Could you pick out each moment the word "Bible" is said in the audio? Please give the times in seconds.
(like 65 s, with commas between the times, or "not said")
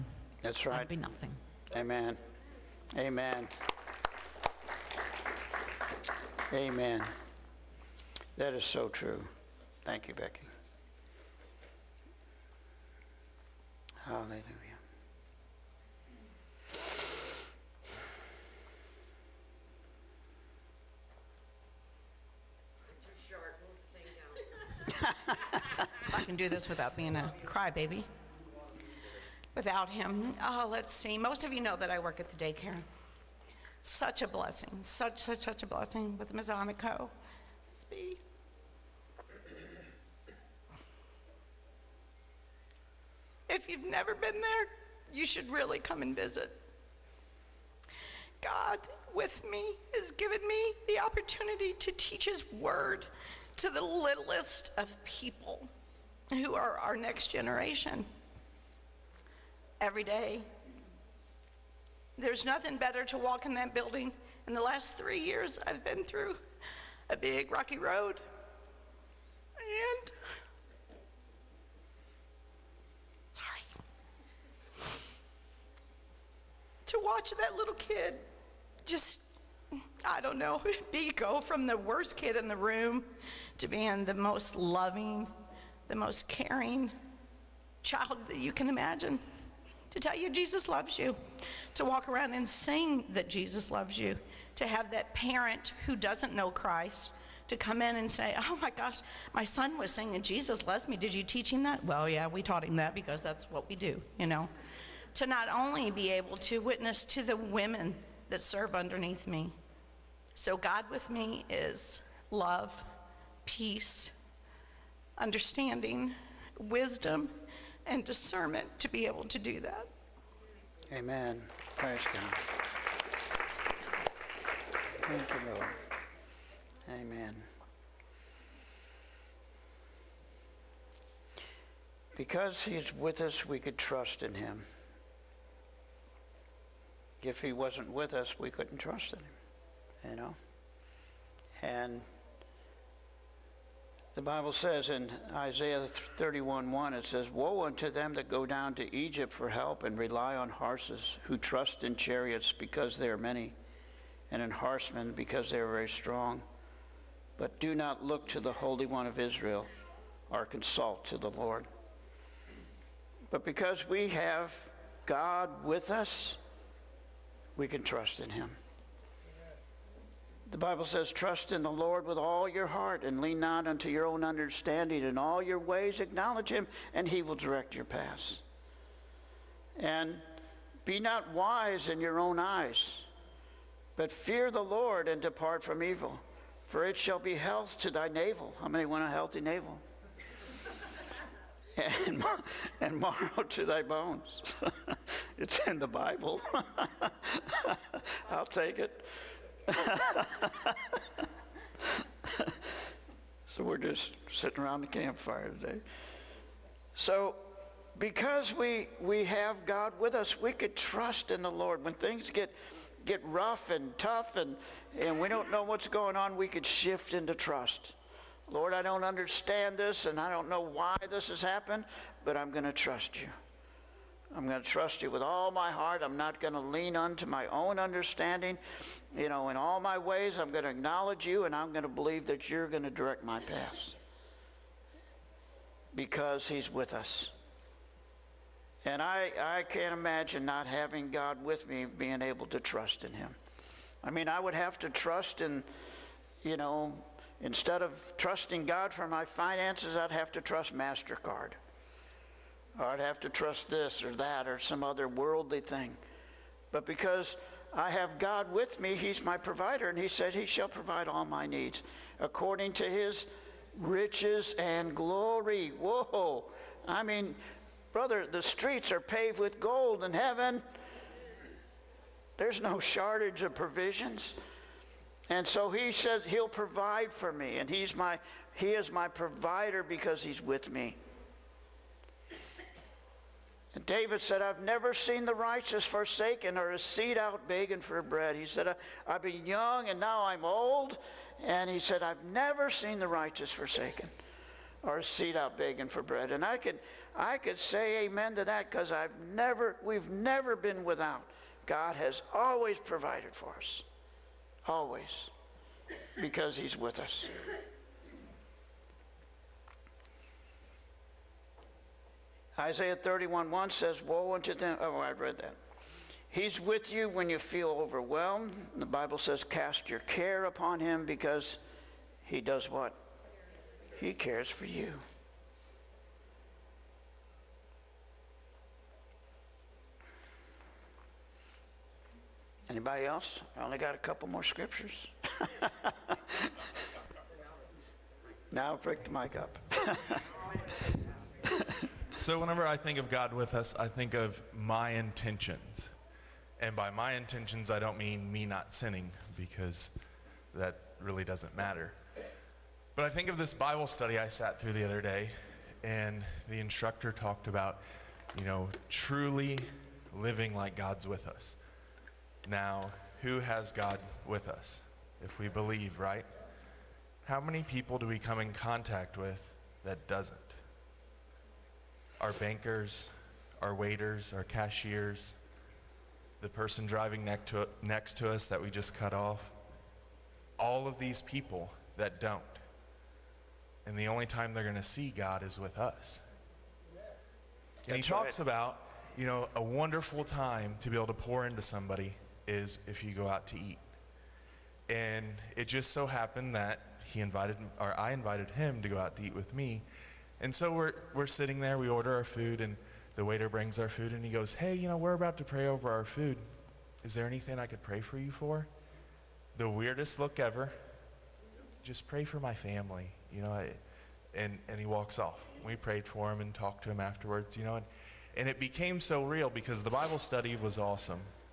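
144 s, 170 s, 195 s, 318 s, 353 s, 419 s.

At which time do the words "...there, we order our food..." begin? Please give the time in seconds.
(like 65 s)
401 s.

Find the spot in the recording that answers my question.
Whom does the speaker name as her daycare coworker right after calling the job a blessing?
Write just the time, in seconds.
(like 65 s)
36 s.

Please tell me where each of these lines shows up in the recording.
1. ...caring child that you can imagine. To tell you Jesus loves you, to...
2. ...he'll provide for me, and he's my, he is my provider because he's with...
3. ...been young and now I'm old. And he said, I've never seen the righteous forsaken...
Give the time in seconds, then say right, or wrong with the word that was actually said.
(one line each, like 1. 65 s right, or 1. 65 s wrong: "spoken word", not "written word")
1. 86 s right
2. 276 s right
3. 289 s right.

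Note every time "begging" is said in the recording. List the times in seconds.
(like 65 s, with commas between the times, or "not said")
287 s, 295 s.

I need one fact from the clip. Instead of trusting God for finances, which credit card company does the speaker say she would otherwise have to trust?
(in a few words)
MasterCard.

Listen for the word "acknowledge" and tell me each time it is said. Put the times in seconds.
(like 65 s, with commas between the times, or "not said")
176 s, 230 s.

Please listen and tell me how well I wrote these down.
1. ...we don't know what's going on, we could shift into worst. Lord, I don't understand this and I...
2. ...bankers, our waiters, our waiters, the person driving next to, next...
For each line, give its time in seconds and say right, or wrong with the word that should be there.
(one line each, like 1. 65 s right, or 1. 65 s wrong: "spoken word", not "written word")
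1. 215 s wrong: "trust", not "worst"
2. 372 s wrong: "cashiers", not "waiters".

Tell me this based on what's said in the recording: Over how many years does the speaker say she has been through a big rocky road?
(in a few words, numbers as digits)
3.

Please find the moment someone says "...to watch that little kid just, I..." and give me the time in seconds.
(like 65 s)
76 s.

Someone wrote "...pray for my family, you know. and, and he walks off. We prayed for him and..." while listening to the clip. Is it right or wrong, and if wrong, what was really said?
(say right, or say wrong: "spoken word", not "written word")
right.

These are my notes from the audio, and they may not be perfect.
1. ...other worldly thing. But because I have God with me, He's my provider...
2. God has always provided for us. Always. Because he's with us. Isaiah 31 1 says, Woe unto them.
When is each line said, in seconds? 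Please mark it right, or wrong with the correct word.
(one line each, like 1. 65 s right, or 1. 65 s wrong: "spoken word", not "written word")
1. 254 s right
2. 301 s right.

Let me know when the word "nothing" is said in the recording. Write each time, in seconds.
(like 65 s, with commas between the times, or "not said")
0 s, 62 s.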